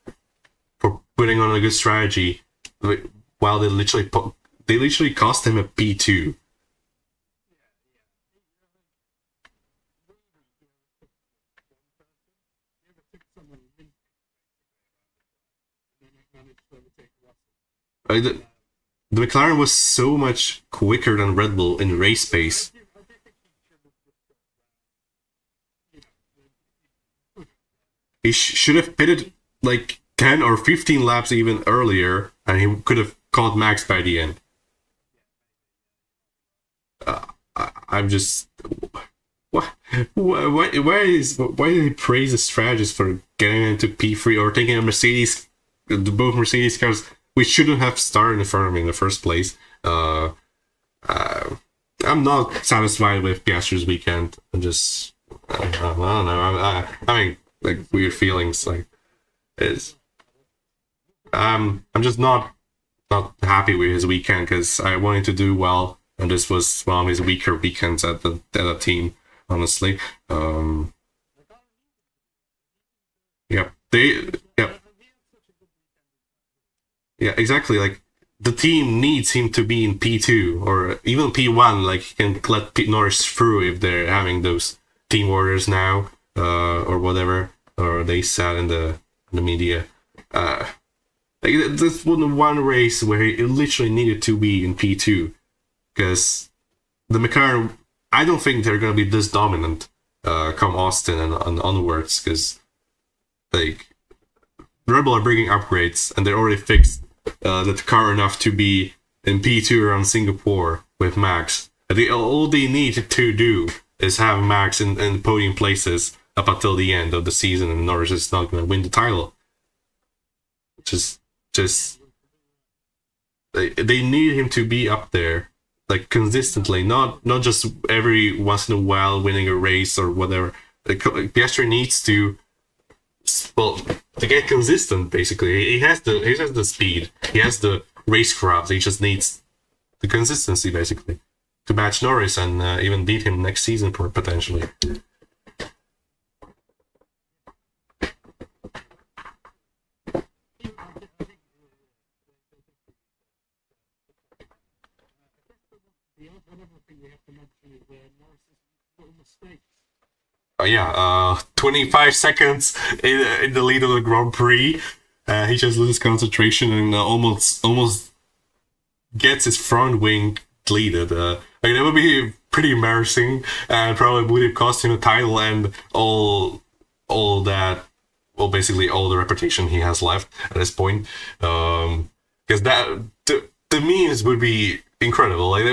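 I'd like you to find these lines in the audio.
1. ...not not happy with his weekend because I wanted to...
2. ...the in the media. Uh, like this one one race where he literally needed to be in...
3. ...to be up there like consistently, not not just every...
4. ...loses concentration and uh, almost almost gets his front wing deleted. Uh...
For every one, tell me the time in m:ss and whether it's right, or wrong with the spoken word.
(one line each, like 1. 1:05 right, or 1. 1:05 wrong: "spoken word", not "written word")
1. 1:02 right
2. 1:28 right
3. 2:04 right
4. 2:45 right.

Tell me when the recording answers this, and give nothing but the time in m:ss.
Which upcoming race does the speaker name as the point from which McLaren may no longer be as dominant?
1:40.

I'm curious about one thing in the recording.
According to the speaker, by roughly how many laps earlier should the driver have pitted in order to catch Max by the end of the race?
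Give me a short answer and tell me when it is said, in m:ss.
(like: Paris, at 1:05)
10 or 15, at 0:30.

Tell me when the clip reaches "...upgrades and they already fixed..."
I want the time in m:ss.
1:45.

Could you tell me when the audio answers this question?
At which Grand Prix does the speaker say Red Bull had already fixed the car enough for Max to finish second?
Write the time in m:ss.
1:50.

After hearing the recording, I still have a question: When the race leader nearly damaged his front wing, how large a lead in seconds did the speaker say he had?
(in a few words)
25 seconds.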